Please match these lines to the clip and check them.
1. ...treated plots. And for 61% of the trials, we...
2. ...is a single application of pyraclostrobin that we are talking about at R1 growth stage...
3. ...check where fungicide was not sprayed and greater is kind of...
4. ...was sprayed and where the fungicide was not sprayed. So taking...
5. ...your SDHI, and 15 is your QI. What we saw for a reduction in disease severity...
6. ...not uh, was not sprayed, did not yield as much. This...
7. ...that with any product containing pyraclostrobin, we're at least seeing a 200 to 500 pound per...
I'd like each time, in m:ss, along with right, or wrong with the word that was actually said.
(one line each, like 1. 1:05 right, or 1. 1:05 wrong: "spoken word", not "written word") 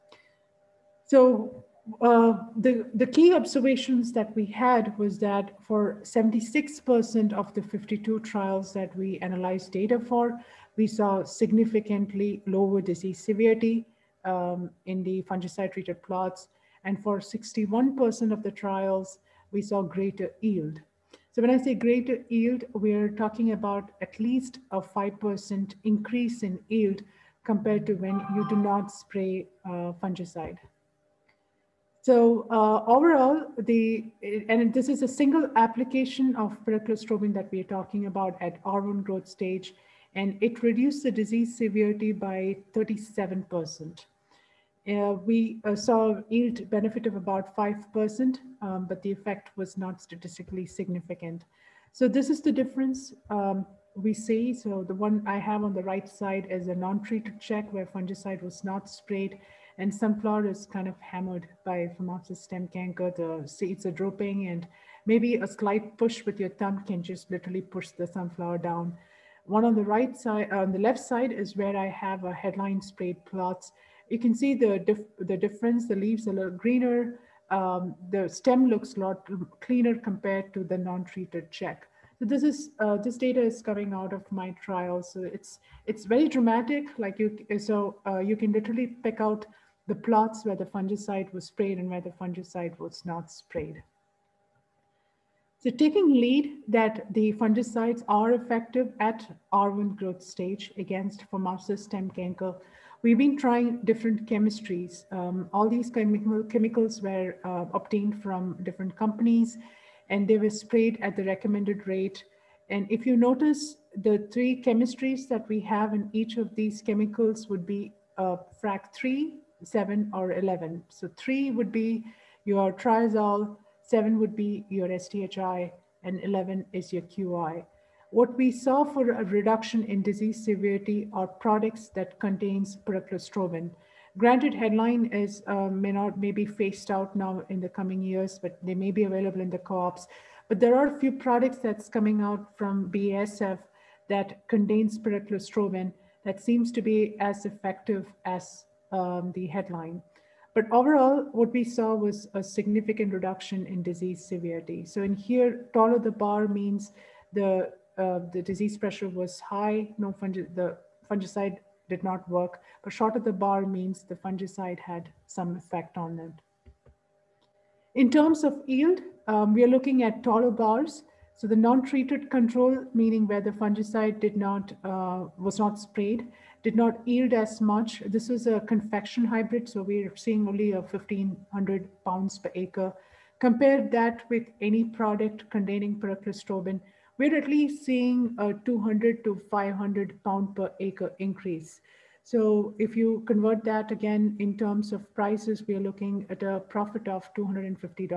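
1. 0:15 right
2. 0:34 right
3. 0:57 wrong: "sunflower", not "greater"
4. 1:31 right
5. 2:04 wrong: "11", not "15"
6. 2:54 right
7. 3:03 right.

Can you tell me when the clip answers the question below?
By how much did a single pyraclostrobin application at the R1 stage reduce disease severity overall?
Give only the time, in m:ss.
0:42.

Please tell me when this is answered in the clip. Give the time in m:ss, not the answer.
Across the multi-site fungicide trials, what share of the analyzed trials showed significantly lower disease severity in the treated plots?
0:06.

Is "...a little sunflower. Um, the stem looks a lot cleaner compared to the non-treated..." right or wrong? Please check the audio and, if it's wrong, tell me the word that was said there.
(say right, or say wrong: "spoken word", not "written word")
wrong: "greener", not "sunflower".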